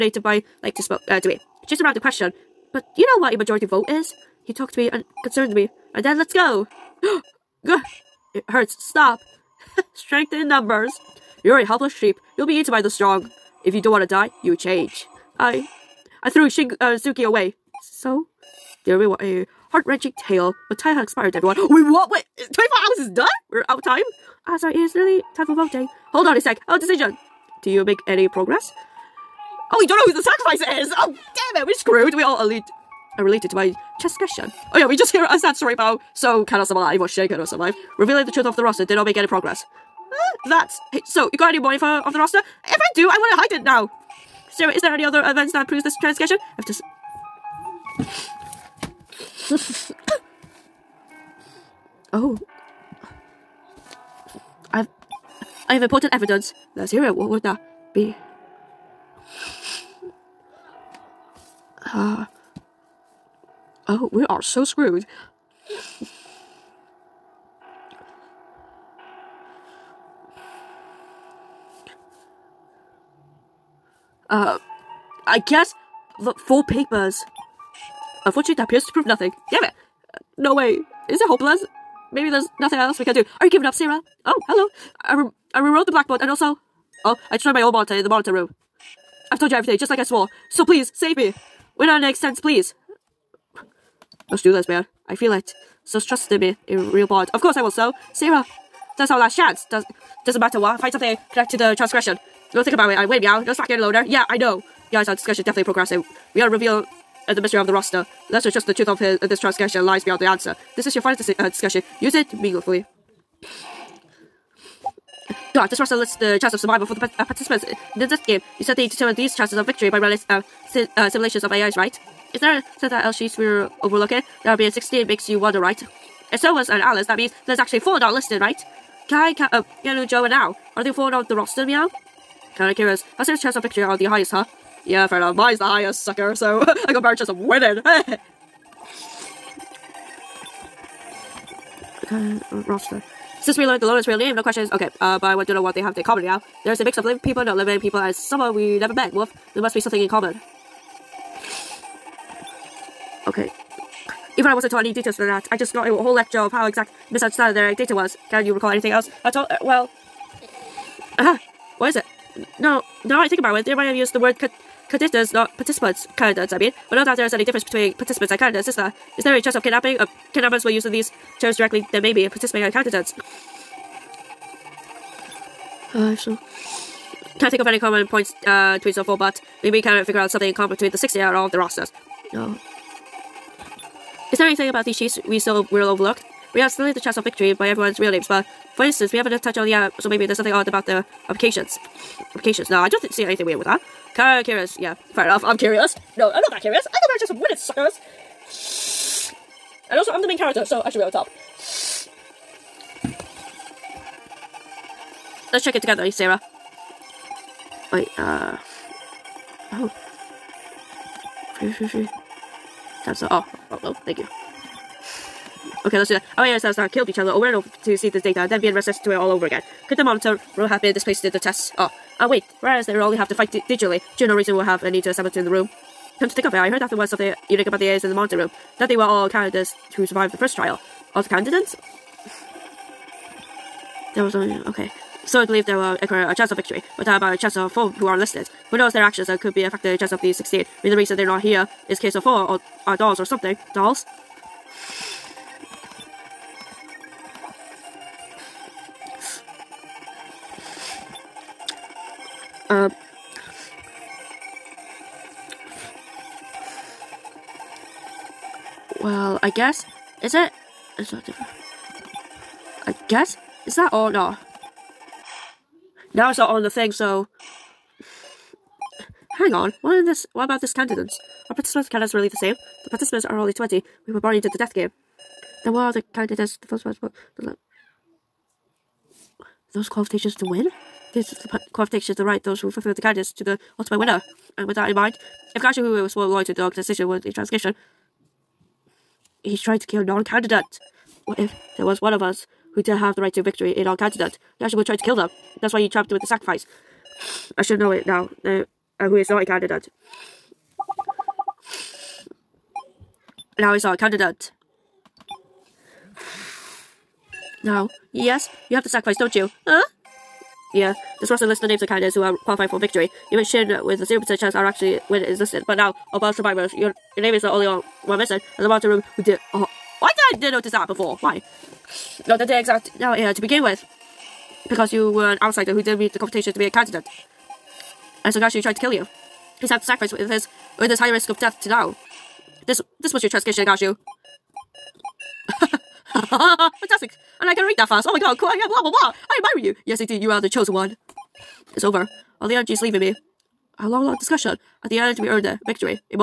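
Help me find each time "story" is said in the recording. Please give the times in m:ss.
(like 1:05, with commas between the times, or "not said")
0:35.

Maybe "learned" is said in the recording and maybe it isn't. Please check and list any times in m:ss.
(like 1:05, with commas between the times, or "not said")
2:23.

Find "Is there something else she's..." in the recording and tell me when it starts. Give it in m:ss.
2:02.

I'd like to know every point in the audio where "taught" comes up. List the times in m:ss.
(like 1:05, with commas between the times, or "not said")
2:34.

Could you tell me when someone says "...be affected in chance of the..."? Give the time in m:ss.
3:59.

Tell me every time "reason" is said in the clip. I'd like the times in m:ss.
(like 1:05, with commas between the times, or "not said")
3:44, 4:00.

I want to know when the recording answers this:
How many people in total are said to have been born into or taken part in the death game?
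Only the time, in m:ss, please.
4:33.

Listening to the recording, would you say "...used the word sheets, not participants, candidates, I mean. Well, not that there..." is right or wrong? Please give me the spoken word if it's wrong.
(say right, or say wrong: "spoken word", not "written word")
wrong: "contestants", not "sheets".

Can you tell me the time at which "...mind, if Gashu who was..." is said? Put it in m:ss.
4:44.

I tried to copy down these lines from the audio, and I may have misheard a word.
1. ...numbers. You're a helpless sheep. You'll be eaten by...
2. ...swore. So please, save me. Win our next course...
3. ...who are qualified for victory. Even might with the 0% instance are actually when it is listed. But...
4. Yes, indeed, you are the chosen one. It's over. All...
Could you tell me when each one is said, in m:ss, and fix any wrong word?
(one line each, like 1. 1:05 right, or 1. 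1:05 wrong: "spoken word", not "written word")
1. 0:10 right
2. 1:30 wrong: "sense", not "course"
3. 5:12 wrong: "chance", not "instance"
4. 5:39 right.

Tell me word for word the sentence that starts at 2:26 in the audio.
There's a mix of living people, not living people, and someone we never met.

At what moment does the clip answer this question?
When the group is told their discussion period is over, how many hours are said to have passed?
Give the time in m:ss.
0:22.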